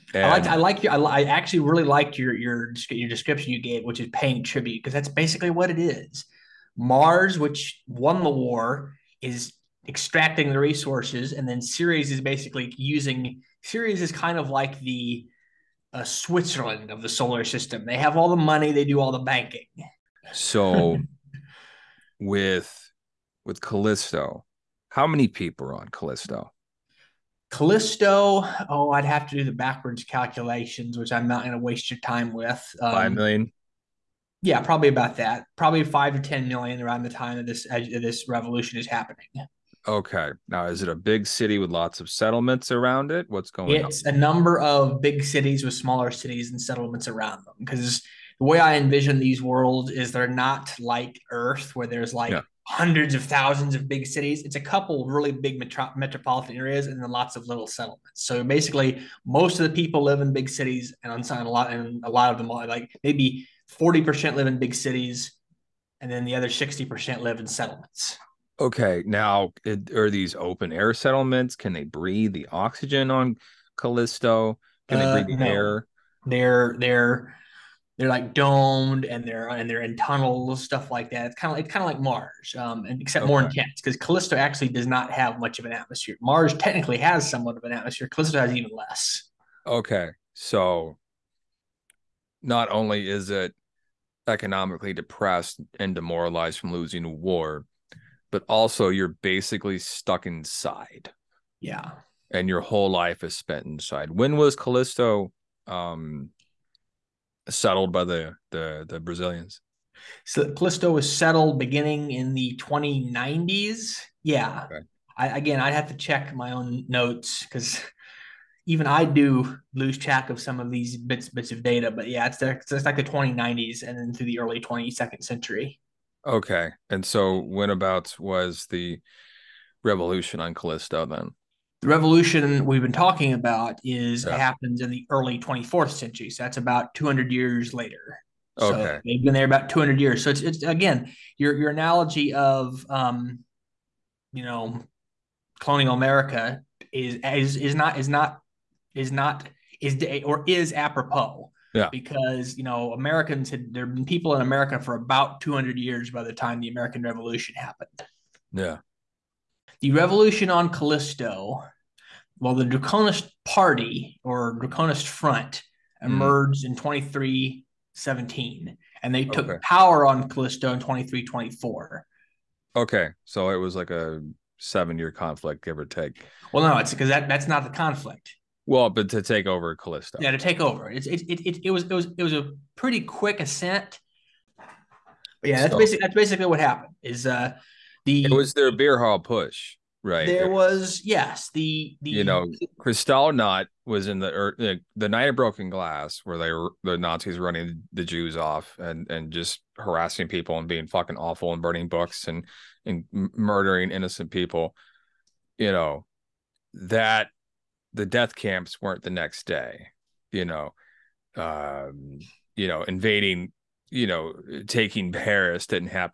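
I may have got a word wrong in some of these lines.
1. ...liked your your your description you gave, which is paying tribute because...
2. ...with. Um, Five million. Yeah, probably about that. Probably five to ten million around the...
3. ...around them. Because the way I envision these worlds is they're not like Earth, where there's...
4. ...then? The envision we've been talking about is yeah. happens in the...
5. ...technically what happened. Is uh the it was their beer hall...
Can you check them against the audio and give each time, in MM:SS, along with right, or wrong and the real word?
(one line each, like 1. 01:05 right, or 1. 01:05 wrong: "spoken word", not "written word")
1. 00:01 right
2. 00:32 right
3. 00:47 right
4. 02:11 wrong: "revolution", not "envision"
5. 03:06 wrong: "basically", not "technically".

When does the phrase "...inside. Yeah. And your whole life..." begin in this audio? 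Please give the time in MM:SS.
01:40.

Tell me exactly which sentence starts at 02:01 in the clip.
But yeah, it's, the, it's like the 2090s and then through the early 22nd century.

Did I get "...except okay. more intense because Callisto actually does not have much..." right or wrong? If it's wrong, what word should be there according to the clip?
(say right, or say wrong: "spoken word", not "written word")
right.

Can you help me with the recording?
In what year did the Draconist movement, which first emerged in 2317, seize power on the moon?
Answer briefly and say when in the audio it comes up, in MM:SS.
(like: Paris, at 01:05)
2324, at 02:50.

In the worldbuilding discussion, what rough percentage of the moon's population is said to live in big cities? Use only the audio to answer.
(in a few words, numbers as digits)
40%.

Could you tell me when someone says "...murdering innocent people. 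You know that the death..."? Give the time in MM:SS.
03:23.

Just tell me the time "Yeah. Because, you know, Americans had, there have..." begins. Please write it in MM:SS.
02:31.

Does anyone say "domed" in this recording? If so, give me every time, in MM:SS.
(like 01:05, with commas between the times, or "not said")
01:18.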